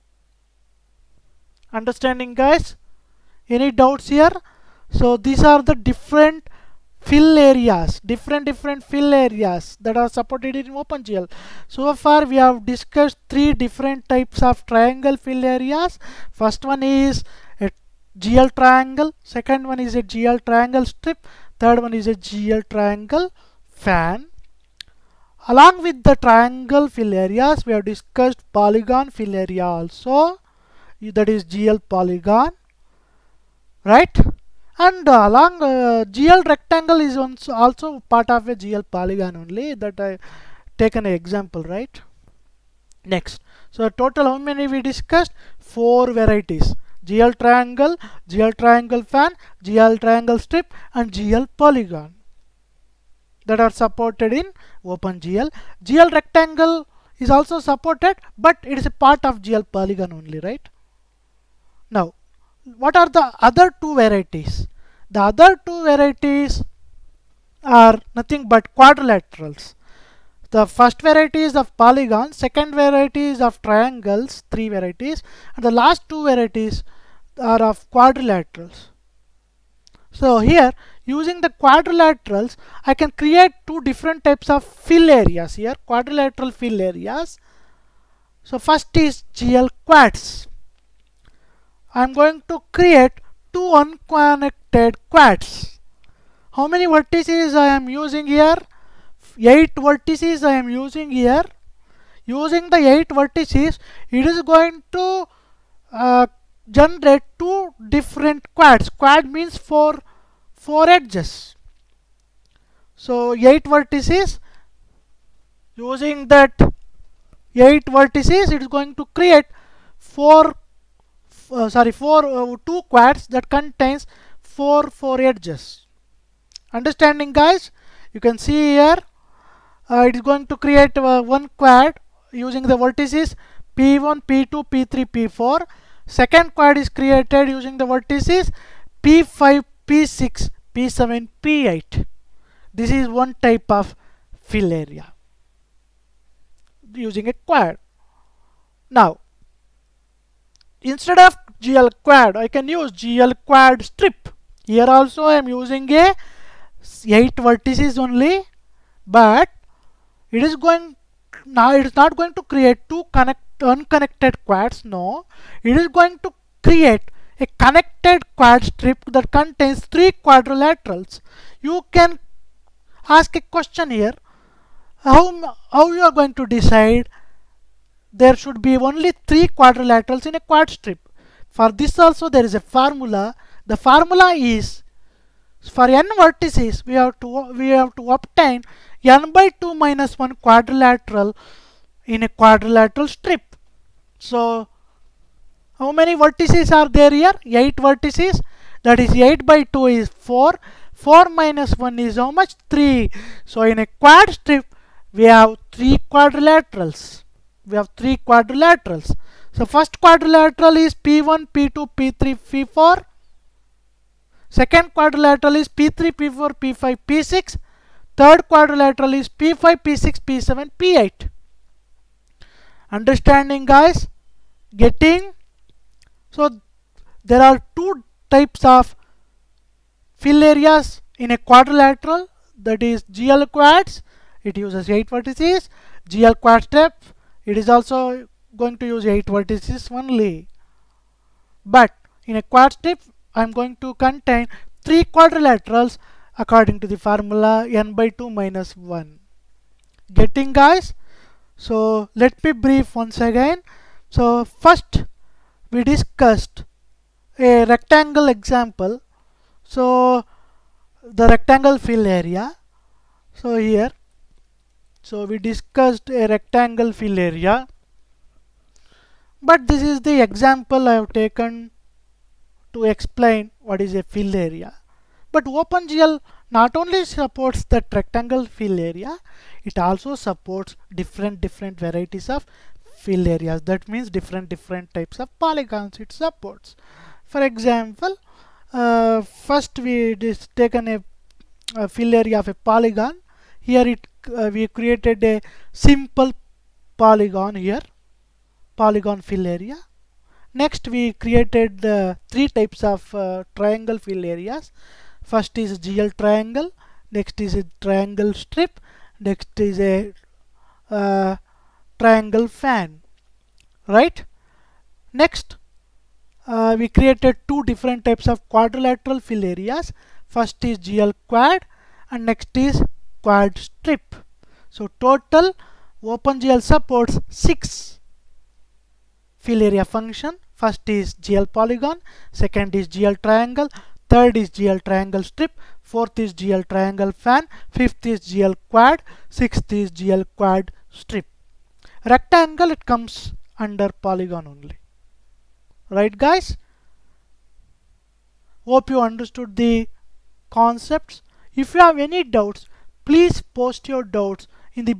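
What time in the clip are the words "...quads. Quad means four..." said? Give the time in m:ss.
1:48.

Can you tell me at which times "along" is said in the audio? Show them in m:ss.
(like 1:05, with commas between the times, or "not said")
0:25, 0:35.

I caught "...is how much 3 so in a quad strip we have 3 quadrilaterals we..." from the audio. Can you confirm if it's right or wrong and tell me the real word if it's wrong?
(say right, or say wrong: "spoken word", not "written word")
right.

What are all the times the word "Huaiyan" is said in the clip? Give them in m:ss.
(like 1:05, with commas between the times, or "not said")
not said.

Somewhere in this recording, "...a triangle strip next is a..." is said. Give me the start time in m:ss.
5:07.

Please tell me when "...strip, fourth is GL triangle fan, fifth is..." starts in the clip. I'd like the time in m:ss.
5:35.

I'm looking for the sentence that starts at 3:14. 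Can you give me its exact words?
So how many vertices are there here?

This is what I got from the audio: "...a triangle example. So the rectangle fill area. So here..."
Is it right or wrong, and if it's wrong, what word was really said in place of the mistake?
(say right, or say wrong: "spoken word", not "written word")
wrong: "rectangle", not "triangle".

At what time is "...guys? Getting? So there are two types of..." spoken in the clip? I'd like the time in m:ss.
3:43.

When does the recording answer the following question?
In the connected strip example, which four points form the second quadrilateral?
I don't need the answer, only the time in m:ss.
3:35.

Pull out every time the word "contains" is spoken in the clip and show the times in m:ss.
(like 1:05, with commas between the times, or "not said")
2:03, 2:49, 4:03.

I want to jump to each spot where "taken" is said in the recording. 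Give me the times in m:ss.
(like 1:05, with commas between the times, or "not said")
0:40, 4:31, 4:50.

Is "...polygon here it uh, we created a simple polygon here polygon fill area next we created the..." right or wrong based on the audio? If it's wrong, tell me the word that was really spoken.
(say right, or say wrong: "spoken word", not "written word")
right.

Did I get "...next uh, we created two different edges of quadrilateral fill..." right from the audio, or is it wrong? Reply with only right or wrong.
wrong.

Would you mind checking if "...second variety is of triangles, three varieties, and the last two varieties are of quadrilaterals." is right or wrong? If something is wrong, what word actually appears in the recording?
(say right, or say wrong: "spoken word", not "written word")
right.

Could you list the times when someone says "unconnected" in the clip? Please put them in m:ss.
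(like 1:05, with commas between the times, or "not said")
1:33, 2:43.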